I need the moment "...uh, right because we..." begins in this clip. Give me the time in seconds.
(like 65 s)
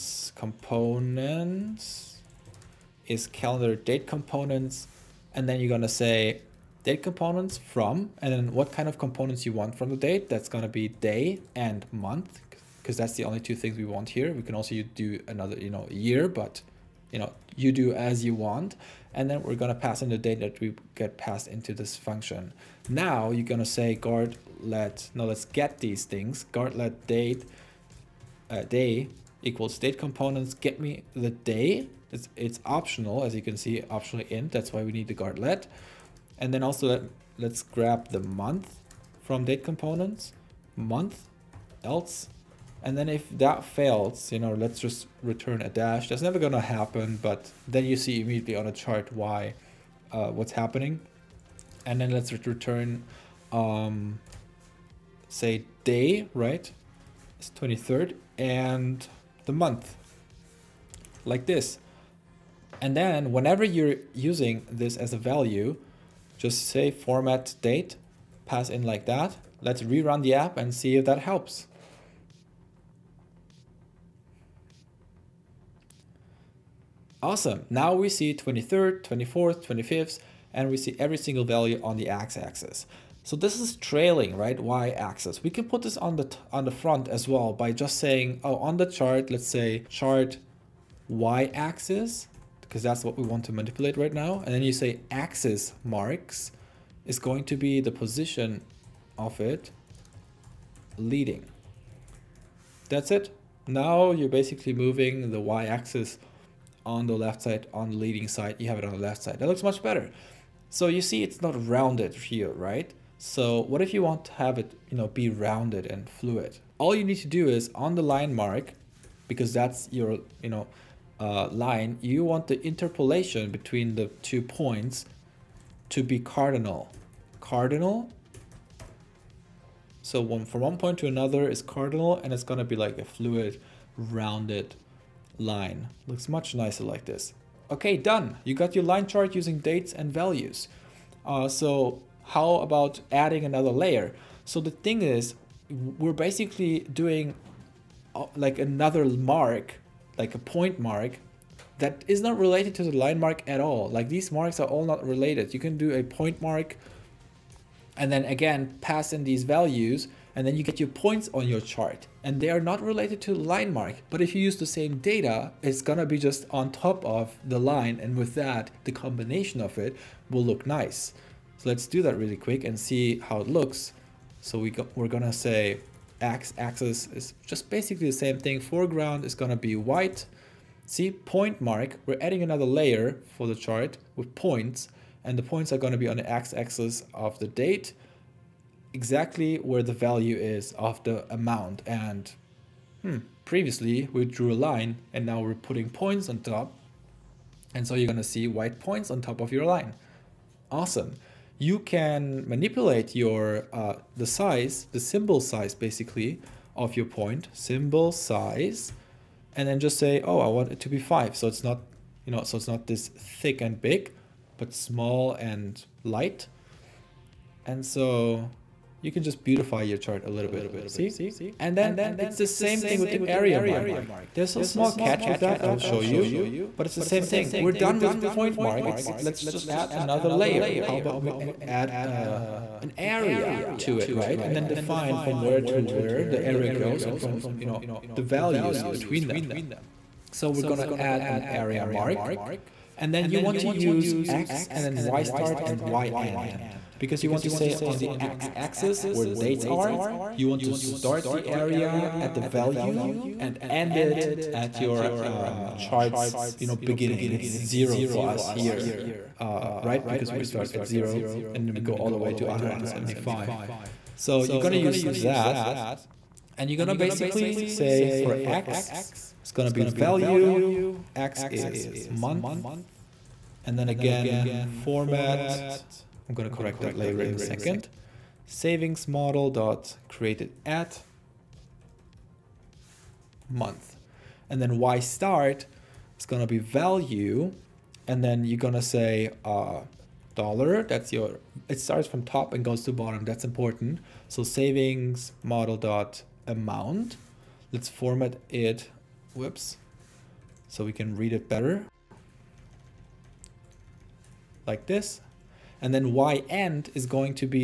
259 s.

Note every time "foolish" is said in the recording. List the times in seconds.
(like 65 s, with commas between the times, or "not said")
not said.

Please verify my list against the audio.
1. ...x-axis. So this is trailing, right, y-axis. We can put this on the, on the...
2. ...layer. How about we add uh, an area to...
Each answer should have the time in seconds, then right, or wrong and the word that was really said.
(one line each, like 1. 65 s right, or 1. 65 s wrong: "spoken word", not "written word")
1. 82 s right
2. 230 s right.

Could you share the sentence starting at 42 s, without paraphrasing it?
And then if that fails, you know, let's just return a dash.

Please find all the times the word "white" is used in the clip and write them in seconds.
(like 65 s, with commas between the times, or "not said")
179 s, 198 s.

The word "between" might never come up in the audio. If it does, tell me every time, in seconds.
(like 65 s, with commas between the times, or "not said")
123 s, 238 s.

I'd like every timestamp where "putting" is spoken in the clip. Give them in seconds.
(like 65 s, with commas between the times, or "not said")
195 s.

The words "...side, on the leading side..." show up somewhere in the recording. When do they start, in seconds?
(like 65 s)
107 s.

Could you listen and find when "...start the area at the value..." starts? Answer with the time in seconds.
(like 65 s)
250 s.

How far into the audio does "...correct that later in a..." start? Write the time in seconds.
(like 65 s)
276 s.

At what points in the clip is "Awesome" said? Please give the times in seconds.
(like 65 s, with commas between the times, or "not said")
77 s, 200 s.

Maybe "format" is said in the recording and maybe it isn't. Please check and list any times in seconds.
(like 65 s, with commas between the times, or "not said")
66 s, 274 s, 297 s.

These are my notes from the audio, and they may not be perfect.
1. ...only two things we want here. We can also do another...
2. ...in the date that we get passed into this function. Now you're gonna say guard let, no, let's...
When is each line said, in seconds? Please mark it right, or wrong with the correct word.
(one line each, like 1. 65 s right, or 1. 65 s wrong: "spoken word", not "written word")
1. 13 s right
2. 20 s right.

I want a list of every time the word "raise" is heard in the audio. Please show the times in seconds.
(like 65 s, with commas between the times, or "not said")
not said.